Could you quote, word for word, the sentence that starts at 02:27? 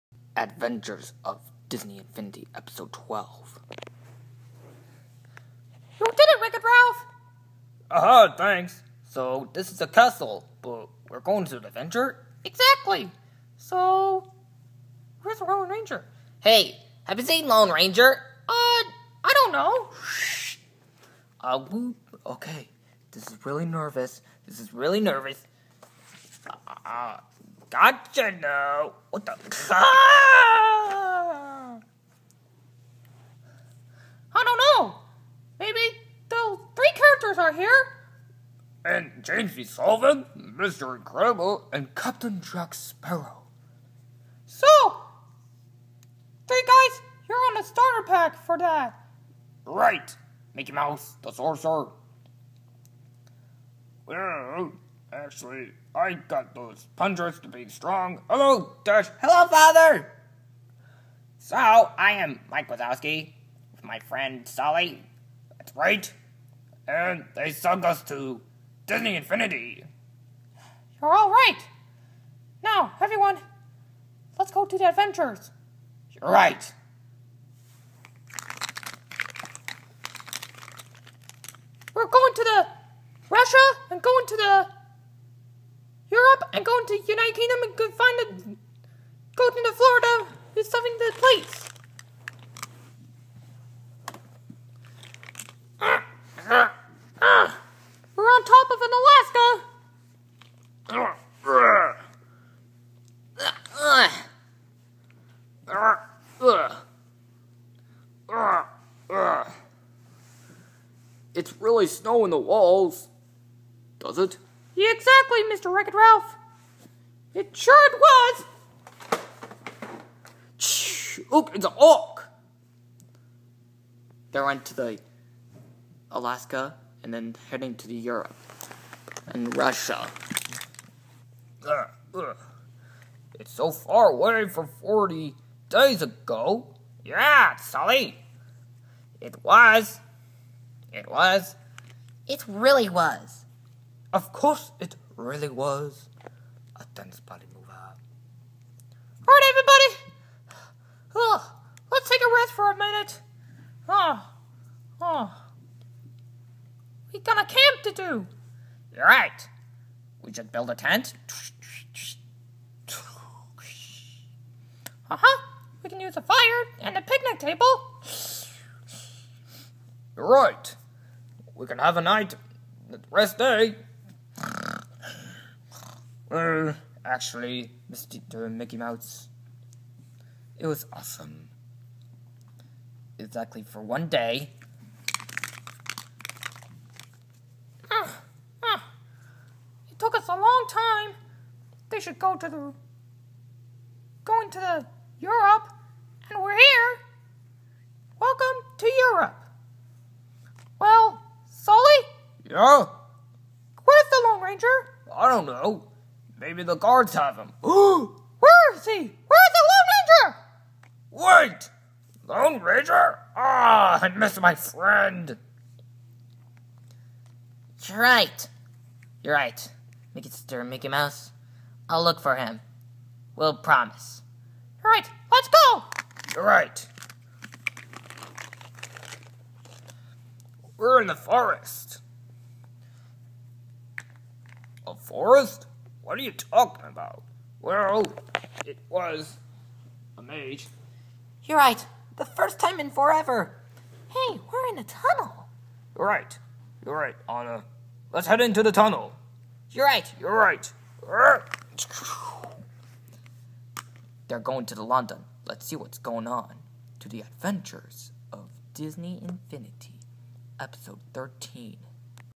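Alright everybody, oh, let's take a rest for a minute.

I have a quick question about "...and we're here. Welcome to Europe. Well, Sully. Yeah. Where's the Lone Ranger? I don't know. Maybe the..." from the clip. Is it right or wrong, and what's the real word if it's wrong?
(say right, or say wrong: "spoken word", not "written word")
right.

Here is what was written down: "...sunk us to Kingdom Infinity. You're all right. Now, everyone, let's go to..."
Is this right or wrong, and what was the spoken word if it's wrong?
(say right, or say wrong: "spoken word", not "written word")
wrong: "Disney", not "Kingdom".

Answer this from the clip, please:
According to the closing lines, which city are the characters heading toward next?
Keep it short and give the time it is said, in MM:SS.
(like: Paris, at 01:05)
London, at 04:14.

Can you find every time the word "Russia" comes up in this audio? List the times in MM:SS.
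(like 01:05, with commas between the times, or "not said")
01:23, 02:09.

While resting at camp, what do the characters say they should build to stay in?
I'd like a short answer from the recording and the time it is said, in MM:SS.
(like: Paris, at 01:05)
A tent, at 02:40.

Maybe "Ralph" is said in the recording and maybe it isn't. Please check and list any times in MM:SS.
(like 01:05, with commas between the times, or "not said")
00:06, 01:55.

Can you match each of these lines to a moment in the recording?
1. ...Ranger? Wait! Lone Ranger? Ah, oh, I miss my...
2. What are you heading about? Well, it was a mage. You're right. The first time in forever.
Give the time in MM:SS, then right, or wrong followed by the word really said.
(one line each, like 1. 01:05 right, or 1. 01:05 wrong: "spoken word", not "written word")
1. 03:30 right
2. 03:56 wrong: "talking", not "heading".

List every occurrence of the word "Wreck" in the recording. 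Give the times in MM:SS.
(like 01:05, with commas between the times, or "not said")
00:06, 01:55.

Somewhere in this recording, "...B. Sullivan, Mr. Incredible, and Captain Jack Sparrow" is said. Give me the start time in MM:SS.
00:39.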